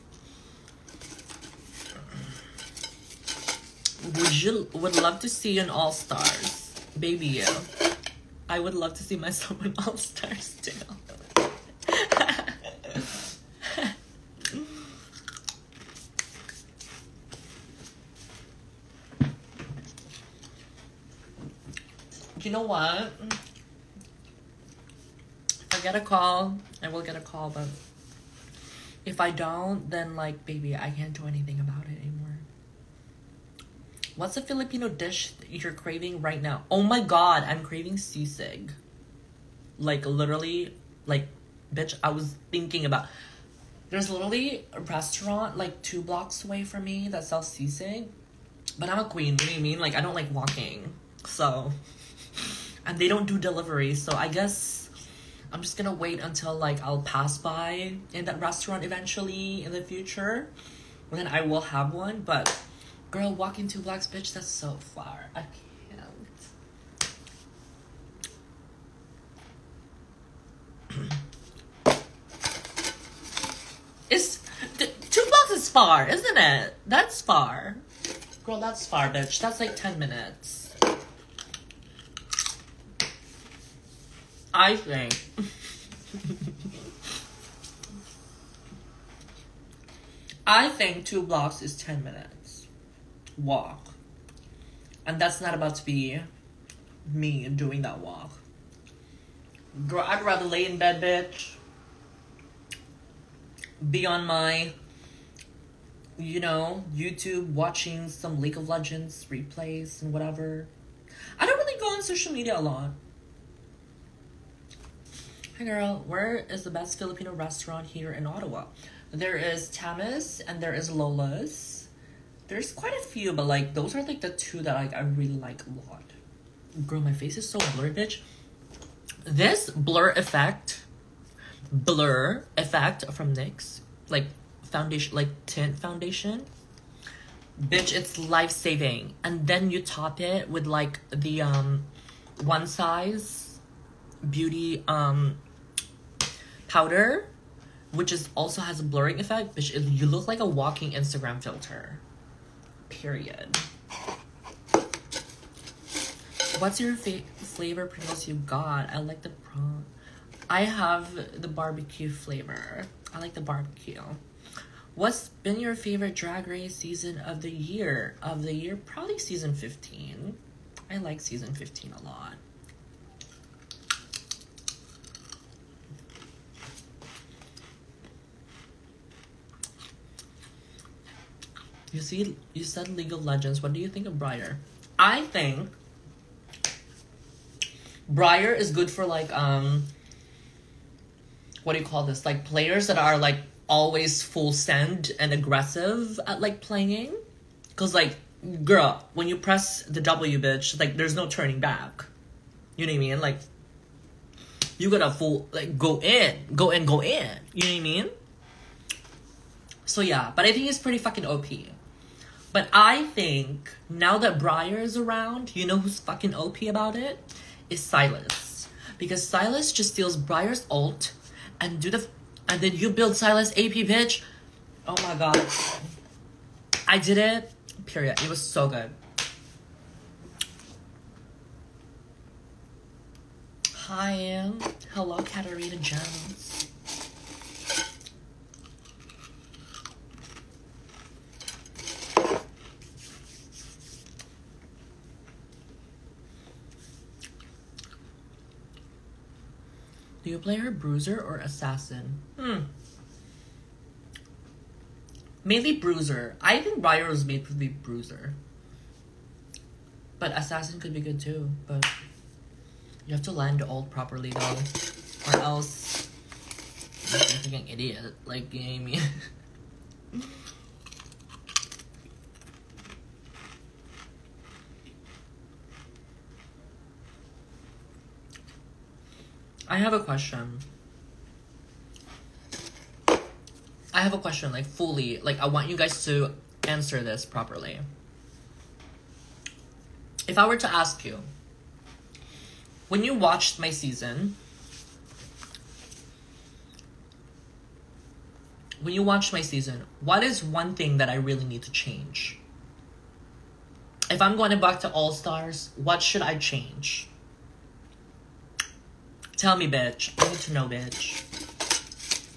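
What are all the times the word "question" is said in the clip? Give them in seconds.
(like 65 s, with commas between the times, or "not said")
280 s, 284 s.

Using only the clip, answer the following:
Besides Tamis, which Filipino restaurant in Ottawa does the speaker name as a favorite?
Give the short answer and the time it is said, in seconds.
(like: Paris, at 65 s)
Lola's, at 120 s.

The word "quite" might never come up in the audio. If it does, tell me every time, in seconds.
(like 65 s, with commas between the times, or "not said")
122 s.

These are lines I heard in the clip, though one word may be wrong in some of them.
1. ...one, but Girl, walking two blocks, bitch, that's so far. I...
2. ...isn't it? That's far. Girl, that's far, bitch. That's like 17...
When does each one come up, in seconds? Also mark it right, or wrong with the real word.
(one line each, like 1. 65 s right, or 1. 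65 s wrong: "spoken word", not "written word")
1. 61 s right
2. 76 s wrong: "10", not "17".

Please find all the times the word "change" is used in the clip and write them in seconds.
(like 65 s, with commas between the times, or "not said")
301 s, 306 s.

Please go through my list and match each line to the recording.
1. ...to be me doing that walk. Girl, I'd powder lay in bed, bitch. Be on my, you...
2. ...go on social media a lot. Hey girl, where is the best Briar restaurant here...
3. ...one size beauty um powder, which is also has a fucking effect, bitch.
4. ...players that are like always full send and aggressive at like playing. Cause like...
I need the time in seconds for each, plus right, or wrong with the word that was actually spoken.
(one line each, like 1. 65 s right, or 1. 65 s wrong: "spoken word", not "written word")
1. 95 s wrong: "rather", not "powder"
2. 111 s wrong: "Filipino", not "Briar"
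3. 142 s wrong: "blurring", not "fucking"
4. 192 s right.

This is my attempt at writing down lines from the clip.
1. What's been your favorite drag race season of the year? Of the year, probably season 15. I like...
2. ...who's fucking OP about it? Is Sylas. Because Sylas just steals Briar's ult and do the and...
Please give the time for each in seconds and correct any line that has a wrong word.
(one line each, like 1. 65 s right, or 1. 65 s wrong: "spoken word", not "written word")
1. 164 s right
2. 215 s right.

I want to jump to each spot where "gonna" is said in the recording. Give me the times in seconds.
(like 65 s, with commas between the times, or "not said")
55 s.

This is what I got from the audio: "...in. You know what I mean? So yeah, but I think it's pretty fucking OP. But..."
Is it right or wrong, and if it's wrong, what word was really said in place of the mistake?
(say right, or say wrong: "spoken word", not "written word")
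right.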